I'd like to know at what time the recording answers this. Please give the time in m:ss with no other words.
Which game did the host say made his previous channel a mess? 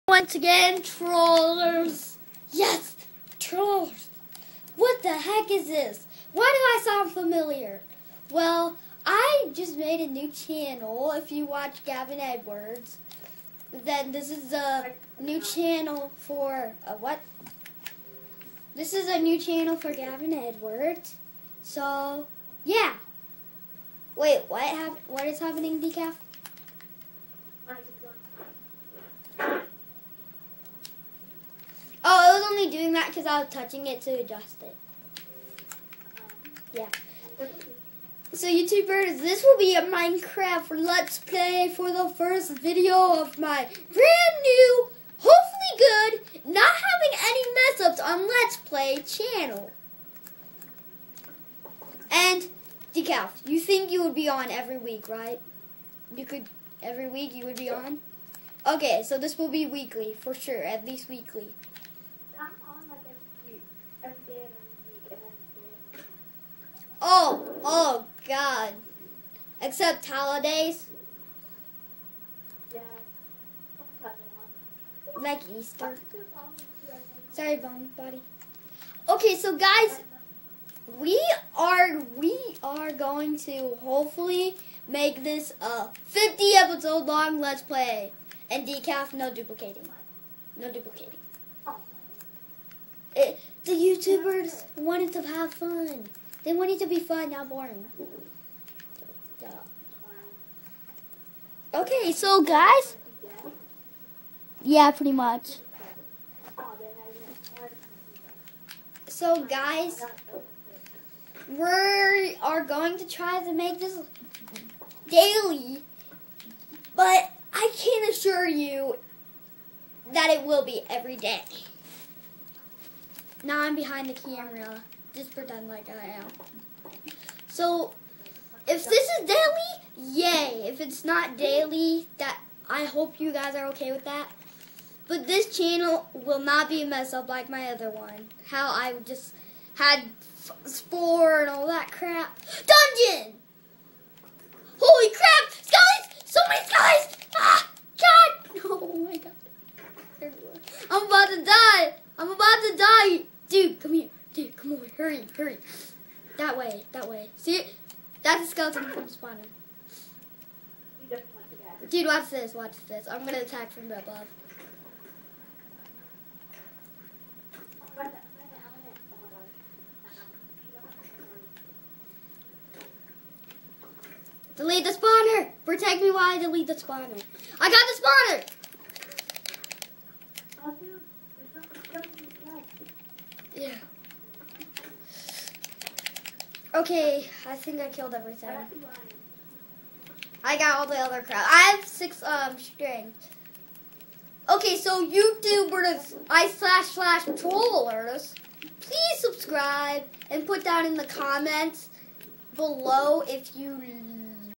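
2:20.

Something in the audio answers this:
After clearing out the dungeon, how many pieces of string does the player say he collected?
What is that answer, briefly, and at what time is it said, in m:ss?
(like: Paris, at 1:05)
6, at 3:11.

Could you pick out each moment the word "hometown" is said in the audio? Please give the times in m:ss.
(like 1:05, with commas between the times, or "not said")
not said.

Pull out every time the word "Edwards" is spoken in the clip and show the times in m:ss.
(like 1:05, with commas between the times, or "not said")
0:12, 0:20.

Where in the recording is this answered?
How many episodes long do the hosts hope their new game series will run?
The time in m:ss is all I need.
1:26.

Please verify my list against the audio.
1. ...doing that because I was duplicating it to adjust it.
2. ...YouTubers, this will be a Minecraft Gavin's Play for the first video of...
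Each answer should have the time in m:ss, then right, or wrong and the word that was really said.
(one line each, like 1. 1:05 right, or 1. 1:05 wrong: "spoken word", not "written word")
1. 0:32 wrong: "touching", not "duplicating"
2. 0:38 wrong: "Let", not "Gavin".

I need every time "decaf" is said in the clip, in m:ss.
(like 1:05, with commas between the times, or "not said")
0:25, 0:52, 1:28.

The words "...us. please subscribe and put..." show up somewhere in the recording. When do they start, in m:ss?
3:17.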